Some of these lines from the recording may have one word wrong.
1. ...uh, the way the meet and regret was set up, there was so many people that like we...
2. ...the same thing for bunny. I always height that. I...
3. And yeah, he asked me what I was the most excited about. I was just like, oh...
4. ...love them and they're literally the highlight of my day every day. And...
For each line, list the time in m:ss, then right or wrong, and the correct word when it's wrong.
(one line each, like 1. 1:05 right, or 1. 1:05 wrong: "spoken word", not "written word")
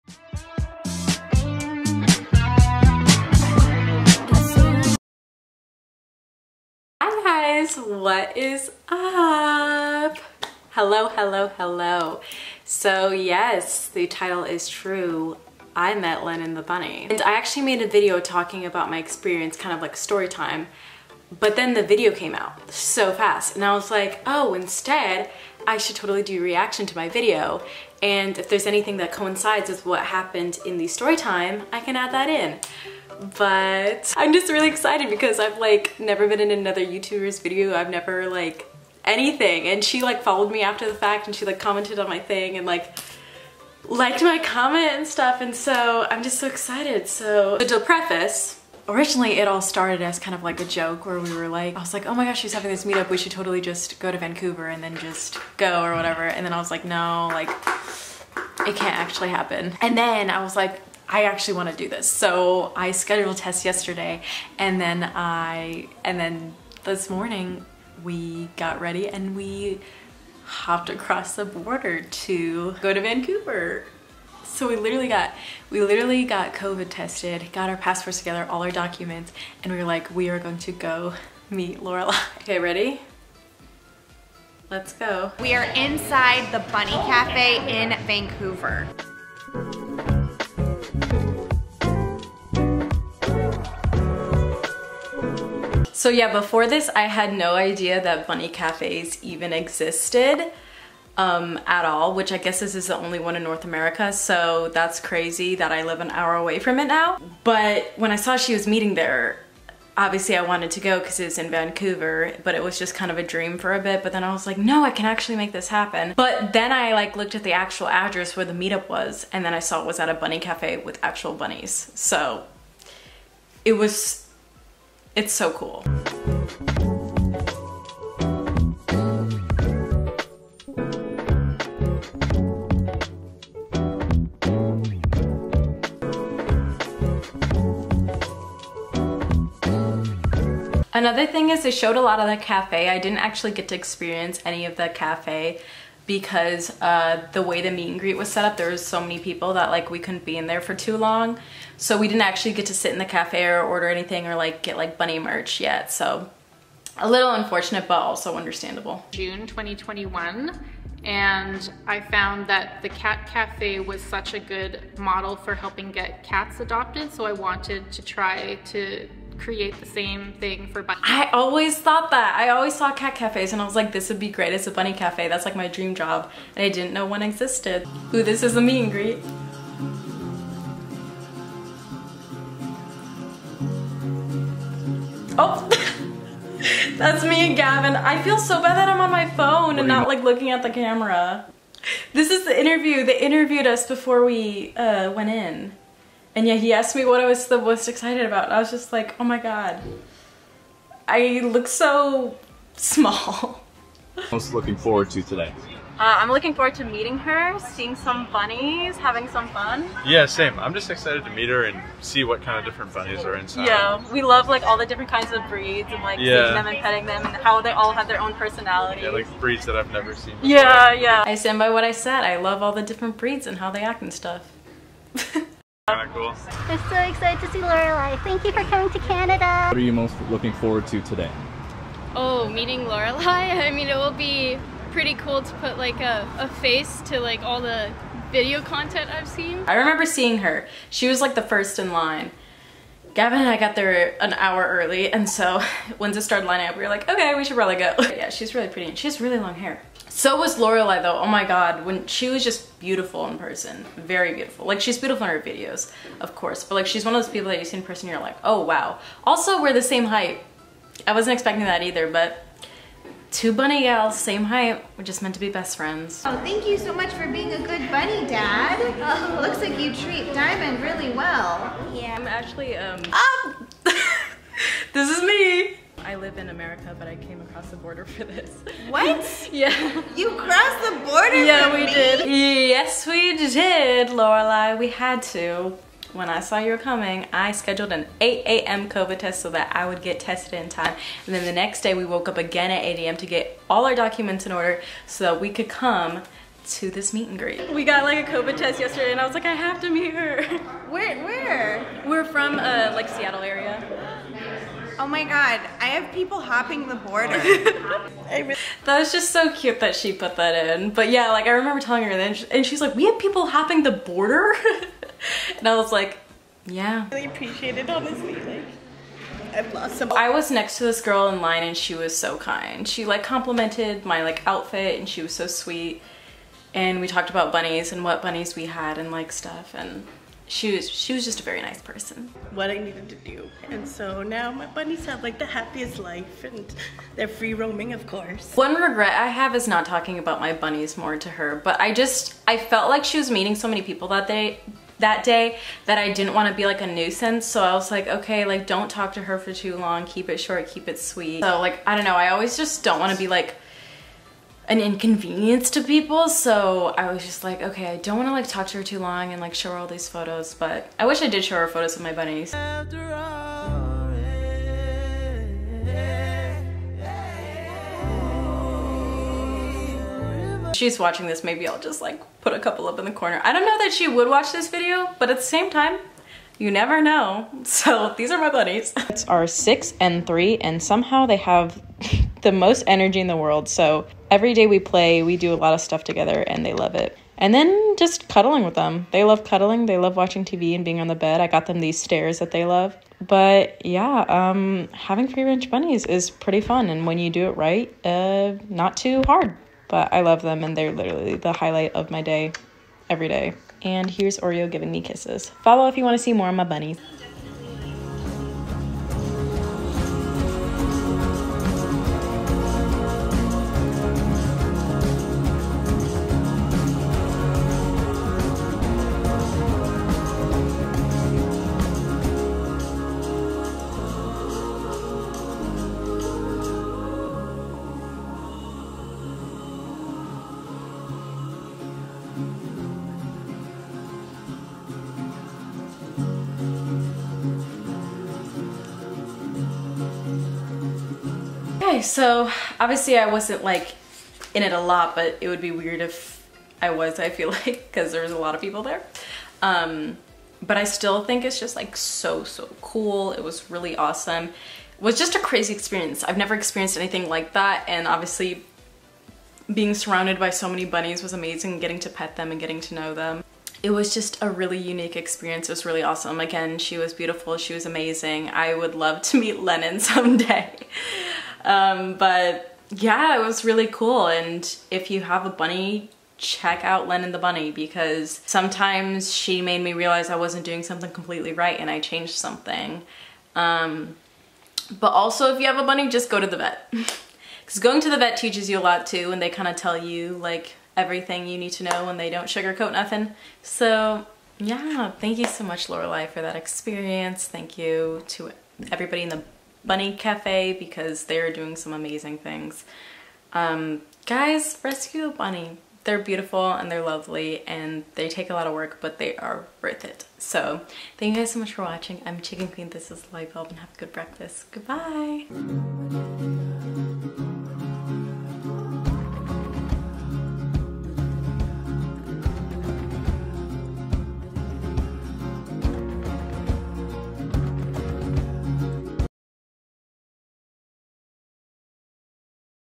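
1. 2:26 wrong: "greet", not "regret"
2. 2:49 wrong: "thought", not "height"
3. 3:16 right
4. 6:40 right.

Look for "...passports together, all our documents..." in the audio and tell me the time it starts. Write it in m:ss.
1:17.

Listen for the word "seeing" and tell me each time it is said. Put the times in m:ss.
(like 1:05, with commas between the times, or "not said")
3:27, 3:36, 4:00.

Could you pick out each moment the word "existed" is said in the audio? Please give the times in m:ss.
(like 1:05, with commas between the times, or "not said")
1:39, 2:57.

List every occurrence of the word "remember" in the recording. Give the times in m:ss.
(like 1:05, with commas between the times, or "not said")
3:59, 5:11.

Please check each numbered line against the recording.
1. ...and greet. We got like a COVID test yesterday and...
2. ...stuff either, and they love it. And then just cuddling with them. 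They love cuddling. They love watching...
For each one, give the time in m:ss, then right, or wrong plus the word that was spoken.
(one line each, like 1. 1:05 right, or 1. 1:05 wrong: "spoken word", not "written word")
1. 4:57 right
2. 6:25 wrong: "together", not "either".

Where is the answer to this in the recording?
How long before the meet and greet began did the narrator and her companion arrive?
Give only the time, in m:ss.
4:04.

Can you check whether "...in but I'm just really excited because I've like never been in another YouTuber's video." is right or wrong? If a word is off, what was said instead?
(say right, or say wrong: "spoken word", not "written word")
right.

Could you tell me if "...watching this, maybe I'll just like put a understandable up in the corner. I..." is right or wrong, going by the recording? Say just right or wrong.
wrong.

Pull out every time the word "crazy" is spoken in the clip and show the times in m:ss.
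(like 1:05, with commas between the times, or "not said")
1:44, 7:35.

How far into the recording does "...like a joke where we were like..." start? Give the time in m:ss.
0:50.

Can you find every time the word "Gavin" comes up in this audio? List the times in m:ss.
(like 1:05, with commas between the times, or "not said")
3:07, 4:03.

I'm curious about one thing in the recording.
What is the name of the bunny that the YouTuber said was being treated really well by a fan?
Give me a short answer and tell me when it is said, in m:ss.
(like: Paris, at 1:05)
Diamond, at 4:30.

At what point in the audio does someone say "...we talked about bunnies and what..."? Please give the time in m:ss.
5:27.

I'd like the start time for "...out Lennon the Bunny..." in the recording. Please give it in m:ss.
7:56.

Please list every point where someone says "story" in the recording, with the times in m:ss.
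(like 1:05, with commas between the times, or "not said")
0:19, 0:30.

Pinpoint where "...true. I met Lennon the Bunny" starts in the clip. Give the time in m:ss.
0:14.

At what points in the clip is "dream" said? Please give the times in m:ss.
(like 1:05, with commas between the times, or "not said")
1:53, 2:55.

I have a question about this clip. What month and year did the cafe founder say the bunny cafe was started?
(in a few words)
June 2021.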